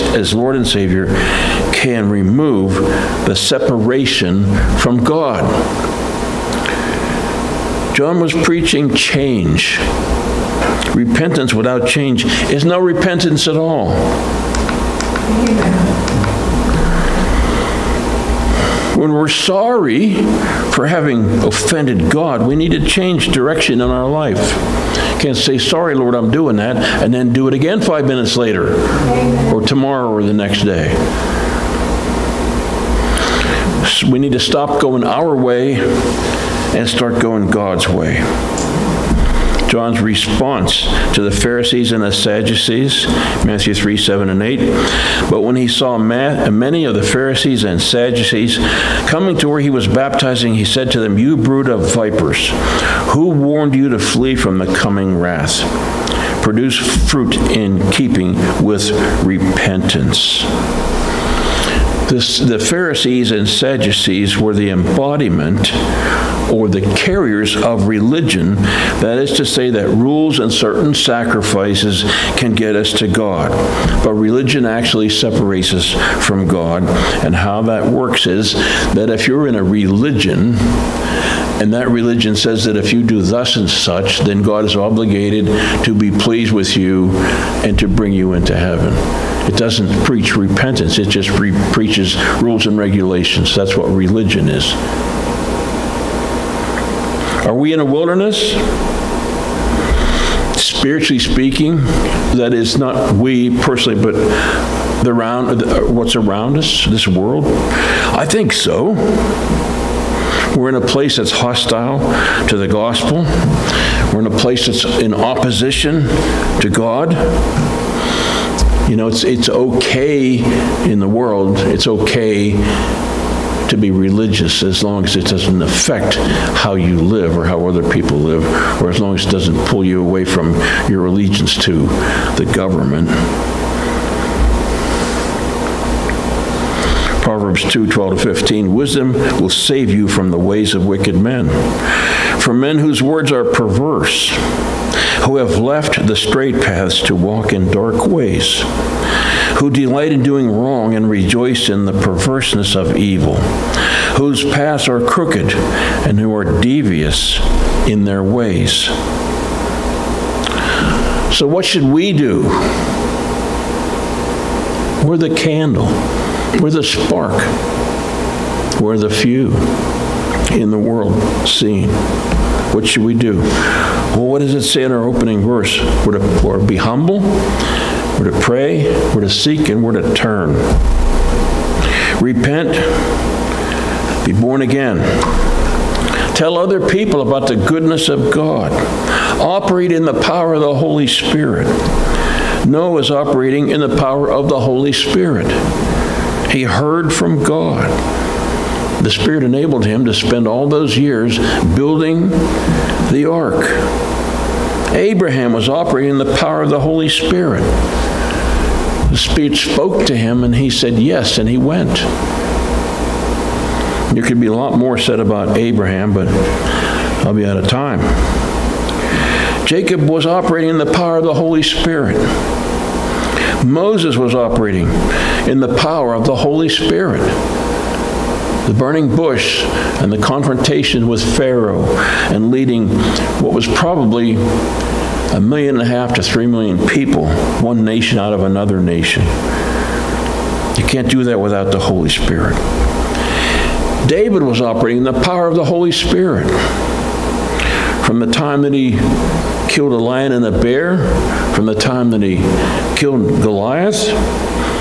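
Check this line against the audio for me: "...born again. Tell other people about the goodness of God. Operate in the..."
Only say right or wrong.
right.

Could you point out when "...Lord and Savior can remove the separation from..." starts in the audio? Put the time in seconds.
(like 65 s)
0 s.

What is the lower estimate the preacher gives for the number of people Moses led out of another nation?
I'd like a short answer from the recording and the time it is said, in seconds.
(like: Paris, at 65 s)
1.5 million, at 235 s.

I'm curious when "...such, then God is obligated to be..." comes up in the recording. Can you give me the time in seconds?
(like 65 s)
83 s.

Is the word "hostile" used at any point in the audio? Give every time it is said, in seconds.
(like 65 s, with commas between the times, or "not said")
111 s.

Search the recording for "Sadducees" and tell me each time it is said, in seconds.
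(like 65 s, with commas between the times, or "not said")
42 s, 47 s, 63 s.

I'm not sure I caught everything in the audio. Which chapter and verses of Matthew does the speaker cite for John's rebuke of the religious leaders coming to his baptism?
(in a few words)
Matthew 3:7-8.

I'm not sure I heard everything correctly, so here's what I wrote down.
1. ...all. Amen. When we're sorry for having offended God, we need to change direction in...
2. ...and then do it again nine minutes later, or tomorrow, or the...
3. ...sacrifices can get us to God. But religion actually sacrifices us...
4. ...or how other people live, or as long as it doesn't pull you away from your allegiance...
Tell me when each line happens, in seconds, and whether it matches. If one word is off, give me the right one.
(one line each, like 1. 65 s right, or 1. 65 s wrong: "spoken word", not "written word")
1. 13 s right
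2. 27 s wrong: "five", not "nine"
3. 70 s wrong: "separates", not "sacrifices"
4. 127 s right.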